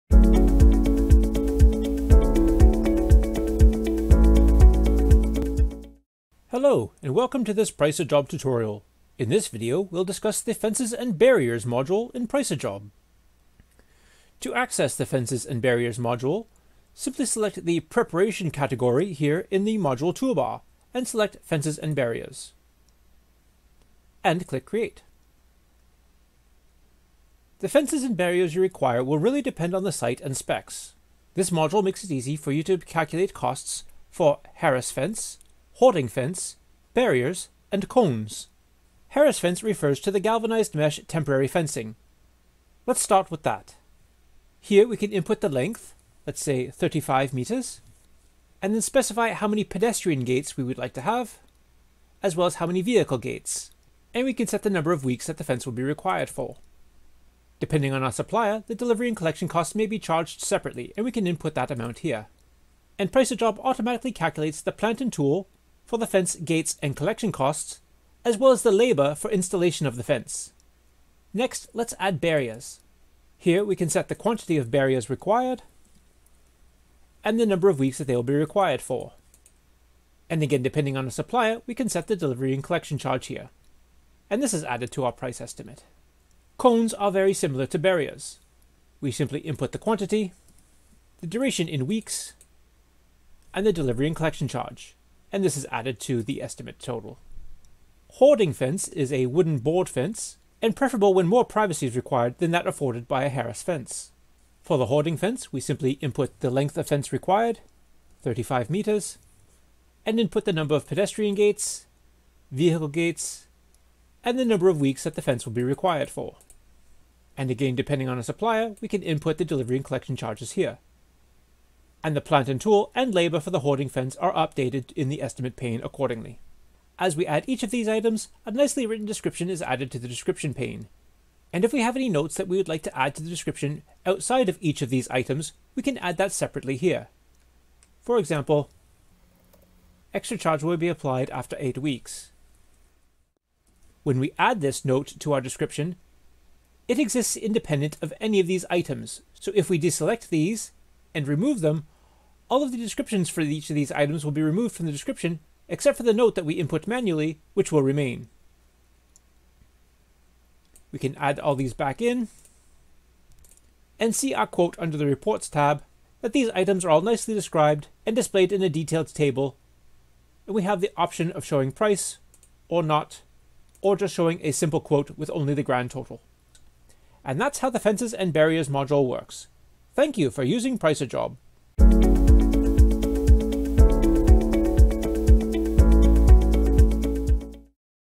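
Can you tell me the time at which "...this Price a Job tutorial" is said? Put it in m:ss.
0:07.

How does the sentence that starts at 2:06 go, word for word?
As we add each of these items, a nicely written description is added to the description pane.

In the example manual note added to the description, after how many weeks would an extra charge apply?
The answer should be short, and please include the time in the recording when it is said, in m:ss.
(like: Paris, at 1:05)
8, at 2:21.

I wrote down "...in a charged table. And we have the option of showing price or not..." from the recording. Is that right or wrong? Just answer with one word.
wrong.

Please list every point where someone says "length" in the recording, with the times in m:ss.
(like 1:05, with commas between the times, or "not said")
0:45, 1:46.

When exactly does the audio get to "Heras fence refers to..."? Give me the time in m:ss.
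0:39.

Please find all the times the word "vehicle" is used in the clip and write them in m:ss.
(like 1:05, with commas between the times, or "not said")
0:52, 1:52.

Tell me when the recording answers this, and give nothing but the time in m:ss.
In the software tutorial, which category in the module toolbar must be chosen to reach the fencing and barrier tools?
0:17.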